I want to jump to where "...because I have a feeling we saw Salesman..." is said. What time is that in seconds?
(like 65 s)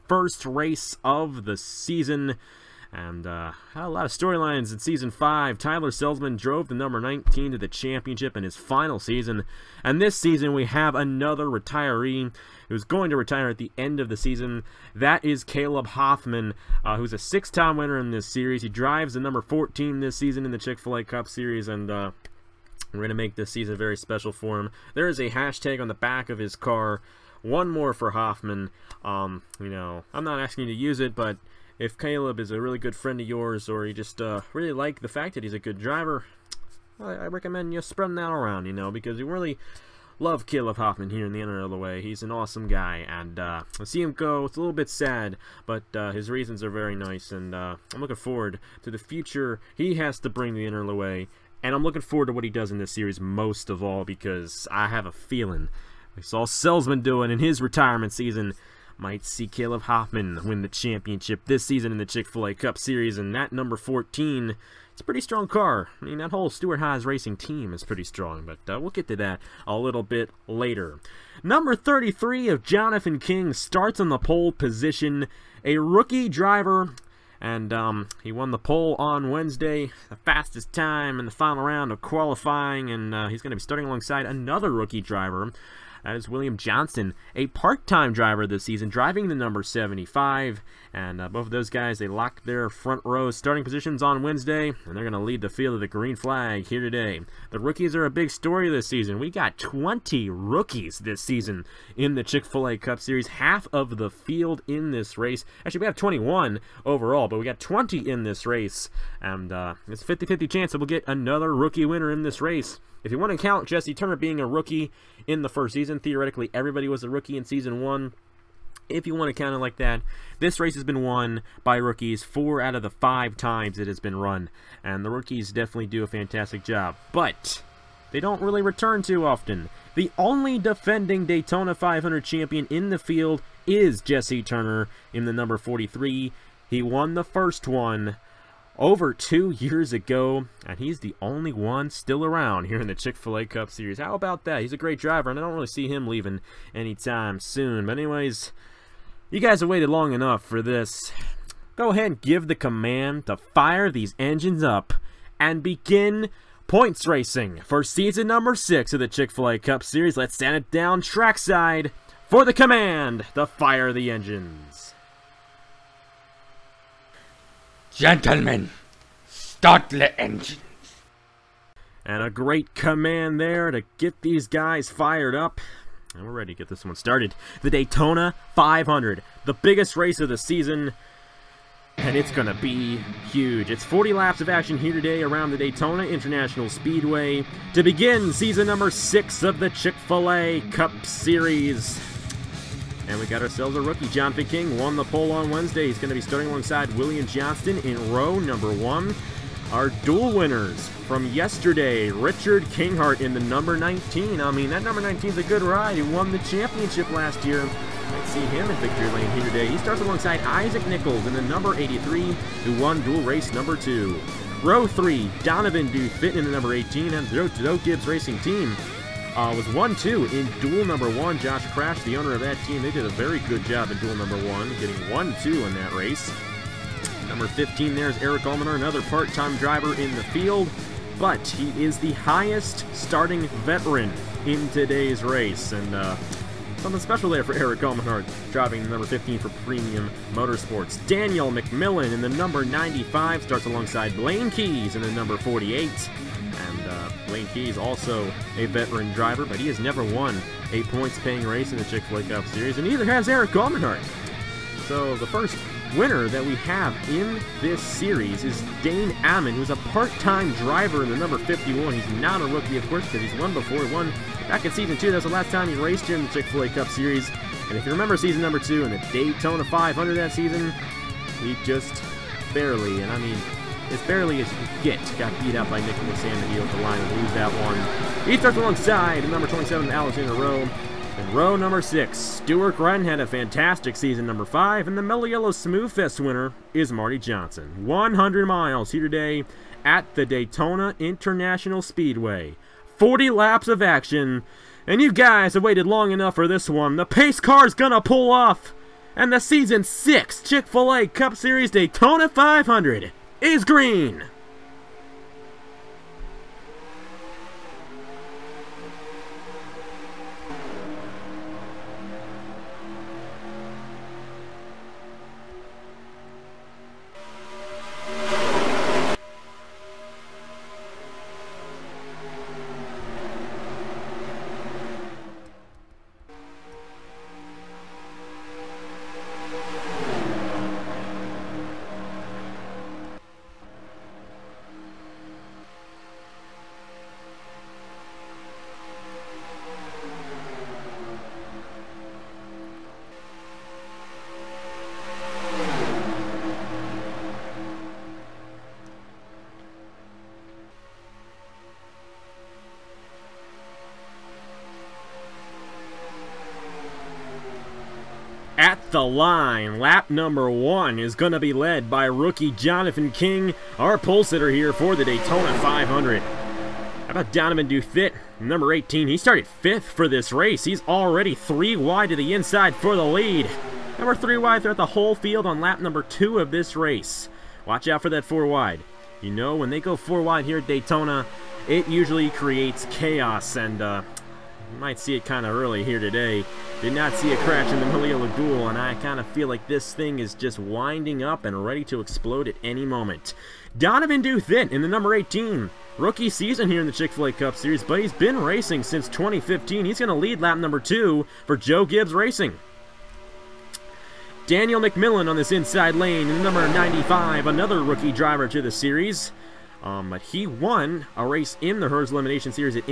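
54 s.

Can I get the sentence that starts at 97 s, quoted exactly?
The rookies are a big story this season.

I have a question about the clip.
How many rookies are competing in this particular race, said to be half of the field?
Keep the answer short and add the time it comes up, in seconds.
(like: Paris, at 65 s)
20, at 107 s.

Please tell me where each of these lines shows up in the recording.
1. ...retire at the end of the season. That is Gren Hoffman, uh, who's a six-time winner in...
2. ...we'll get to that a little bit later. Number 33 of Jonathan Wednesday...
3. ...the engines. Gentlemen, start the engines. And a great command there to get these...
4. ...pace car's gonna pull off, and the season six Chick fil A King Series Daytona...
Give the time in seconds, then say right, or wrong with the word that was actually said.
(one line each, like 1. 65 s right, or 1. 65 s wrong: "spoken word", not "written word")
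1. 13 s wrong: "Caleb", not "Gren"
2. 68 s wrong: "King", not "Wednesday"
3. 163 s right
4. 297 s wrong: "Cup", not "King".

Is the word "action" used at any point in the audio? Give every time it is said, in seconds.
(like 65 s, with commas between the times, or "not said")
184 s, 293 s.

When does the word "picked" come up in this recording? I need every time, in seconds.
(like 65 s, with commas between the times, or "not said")
not said.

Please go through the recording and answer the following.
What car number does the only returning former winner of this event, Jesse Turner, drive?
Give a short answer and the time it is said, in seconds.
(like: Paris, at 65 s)
43, at 135 s.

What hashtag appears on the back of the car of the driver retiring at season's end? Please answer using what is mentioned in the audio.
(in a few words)
One more for Hoffman.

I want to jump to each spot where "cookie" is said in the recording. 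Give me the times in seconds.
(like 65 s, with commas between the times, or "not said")
not said.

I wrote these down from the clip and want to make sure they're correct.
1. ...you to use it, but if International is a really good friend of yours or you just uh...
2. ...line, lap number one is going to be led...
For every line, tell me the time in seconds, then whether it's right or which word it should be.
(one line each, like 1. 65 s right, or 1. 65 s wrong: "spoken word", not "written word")
1. 30 s wrong: "Caleb", not "International"
2. 359 s right.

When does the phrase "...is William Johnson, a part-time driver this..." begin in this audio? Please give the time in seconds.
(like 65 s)
86 s.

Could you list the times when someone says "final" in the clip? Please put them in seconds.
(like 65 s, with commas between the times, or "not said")
8 s, 81 s.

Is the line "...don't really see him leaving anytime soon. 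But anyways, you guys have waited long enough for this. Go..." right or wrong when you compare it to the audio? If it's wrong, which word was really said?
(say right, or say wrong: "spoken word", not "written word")
right.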